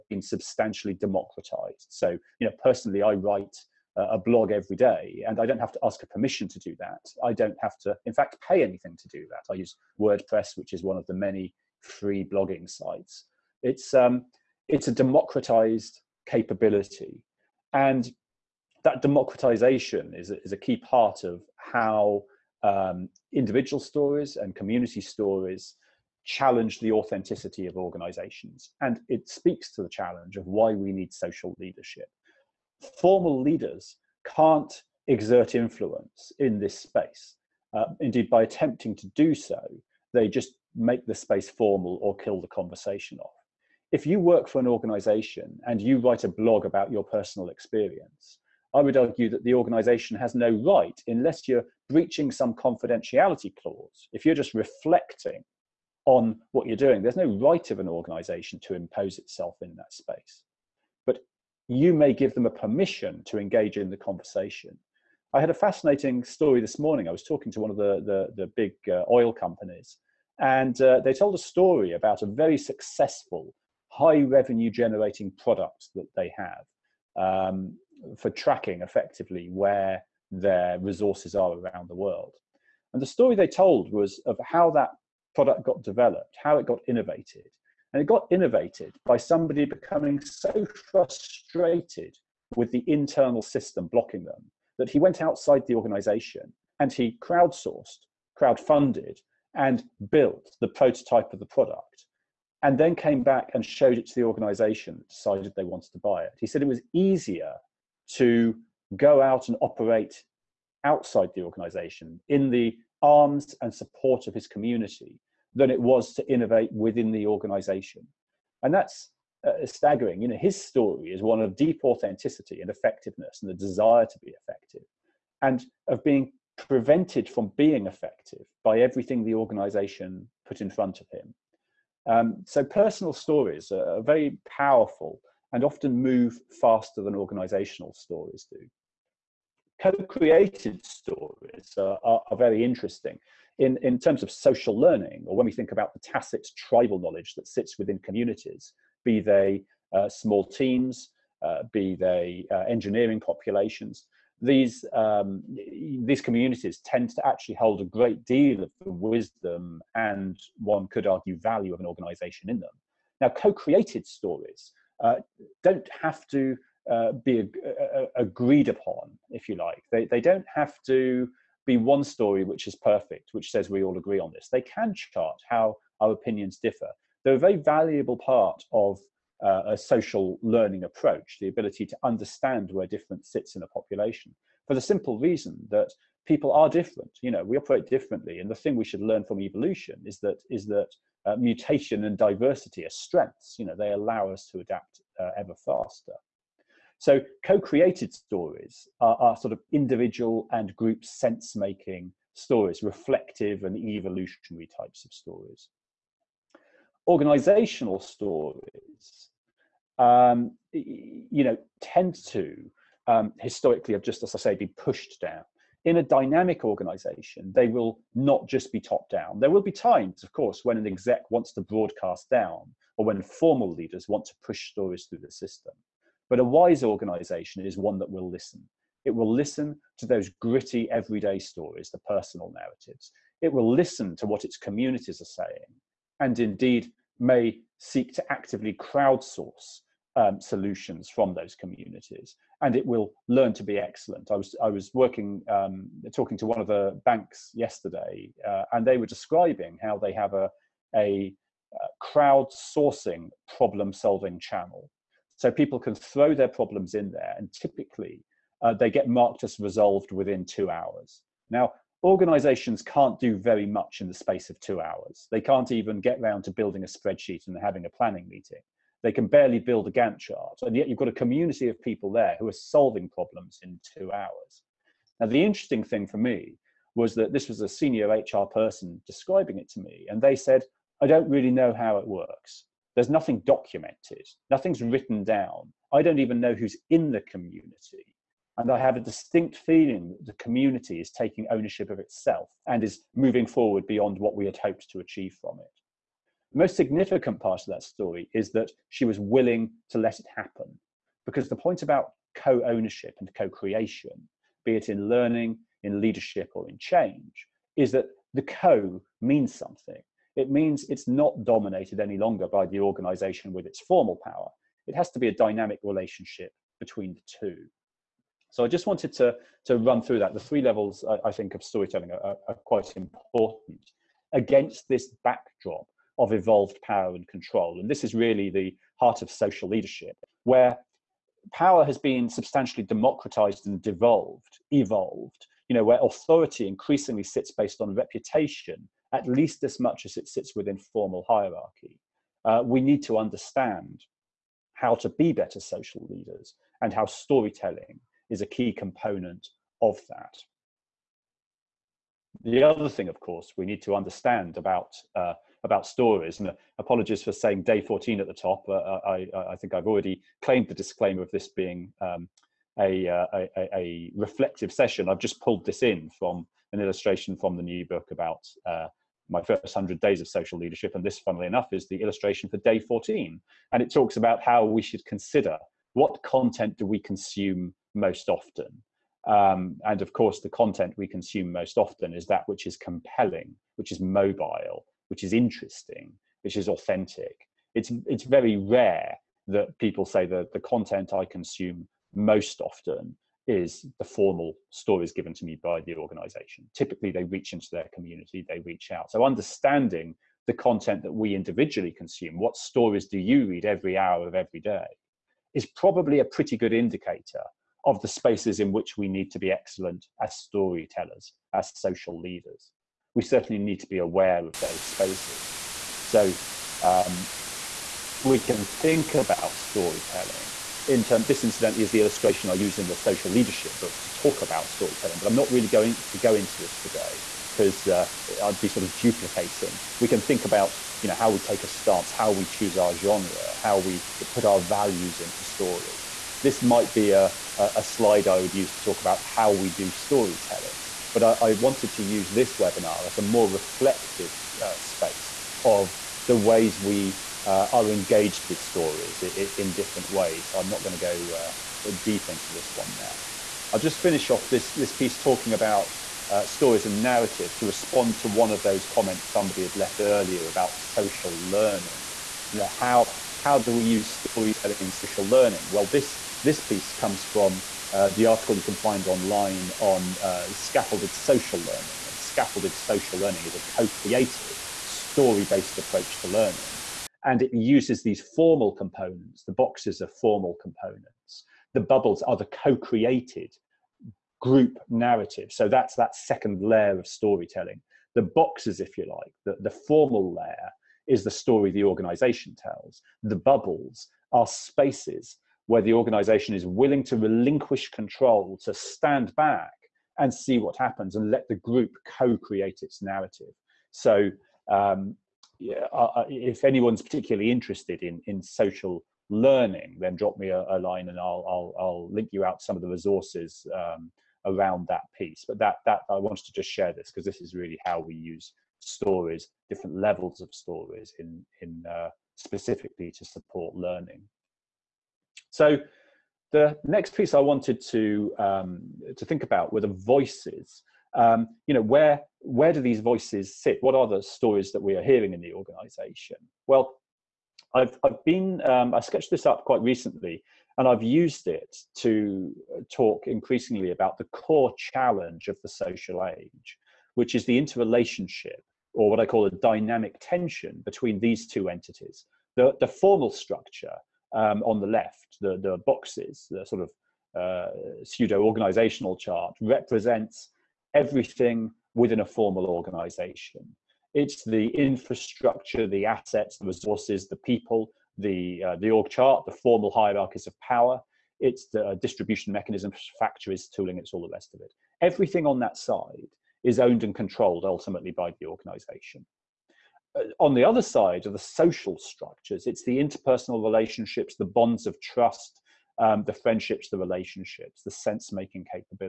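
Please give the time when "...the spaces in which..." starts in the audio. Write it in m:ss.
6:48.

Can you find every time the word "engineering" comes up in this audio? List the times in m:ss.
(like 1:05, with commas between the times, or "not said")
2:32.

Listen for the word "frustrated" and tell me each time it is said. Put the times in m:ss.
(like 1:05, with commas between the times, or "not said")
1:30.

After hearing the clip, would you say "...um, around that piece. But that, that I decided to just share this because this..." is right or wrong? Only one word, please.
wrong.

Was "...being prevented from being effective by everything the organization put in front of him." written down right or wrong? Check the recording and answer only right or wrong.
right.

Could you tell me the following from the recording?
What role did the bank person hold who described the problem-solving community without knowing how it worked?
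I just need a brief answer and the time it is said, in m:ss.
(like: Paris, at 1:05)
Senior HR person, at 4:37.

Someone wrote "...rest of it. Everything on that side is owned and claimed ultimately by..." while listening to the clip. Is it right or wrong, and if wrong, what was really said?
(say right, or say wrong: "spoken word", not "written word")
wrong: "controlled", not "claimed".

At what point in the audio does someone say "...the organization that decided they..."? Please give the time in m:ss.
1:44.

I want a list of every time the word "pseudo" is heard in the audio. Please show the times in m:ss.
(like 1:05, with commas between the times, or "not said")
9:18.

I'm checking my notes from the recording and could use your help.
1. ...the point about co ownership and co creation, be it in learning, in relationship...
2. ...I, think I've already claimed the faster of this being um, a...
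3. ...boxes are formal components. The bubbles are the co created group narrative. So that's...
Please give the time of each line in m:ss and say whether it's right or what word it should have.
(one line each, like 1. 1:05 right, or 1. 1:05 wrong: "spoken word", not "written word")
1. 5:01 wrong: "leadership", not "relationship"
2. 5:59 wrong: "disclaimer", not "faster"
3. 7:59 right.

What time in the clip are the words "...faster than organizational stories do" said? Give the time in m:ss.
2:16.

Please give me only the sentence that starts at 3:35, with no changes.
In a dynamic organization, they will not just be top down.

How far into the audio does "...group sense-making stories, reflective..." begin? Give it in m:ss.
3:20.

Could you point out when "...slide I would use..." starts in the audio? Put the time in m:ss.
7:17.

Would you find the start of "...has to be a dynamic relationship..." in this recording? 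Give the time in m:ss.
5:14.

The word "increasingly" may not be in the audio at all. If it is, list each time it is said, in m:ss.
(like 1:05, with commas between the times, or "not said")
5:36, 9:03.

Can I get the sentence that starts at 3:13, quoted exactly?
You know, they allow us to adapt uh, ever faster.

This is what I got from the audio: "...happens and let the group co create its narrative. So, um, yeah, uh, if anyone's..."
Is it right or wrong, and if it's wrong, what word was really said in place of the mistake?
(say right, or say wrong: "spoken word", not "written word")
right.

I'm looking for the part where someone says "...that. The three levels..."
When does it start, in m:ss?
5:20.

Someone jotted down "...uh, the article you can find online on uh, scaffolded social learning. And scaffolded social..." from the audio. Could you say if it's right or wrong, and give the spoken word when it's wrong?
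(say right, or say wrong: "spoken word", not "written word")
right.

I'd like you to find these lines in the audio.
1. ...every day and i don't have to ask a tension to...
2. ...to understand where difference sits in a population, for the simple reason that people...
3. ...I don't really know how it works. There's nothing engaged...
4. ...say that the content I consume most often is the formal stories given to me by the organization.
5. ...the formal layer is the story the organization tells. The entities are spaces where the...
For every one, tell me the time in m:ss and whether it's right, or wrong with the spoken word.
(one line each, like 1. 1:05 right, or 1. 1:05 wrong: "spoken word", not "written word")
1. 0:04 wrong: "permission", not "tension"
2. 3:01 right
3. 4:41 wrong: "documented", not "engaged"
4. 6:30 right
5. 8:09 wrong: "bubbles", not "entities".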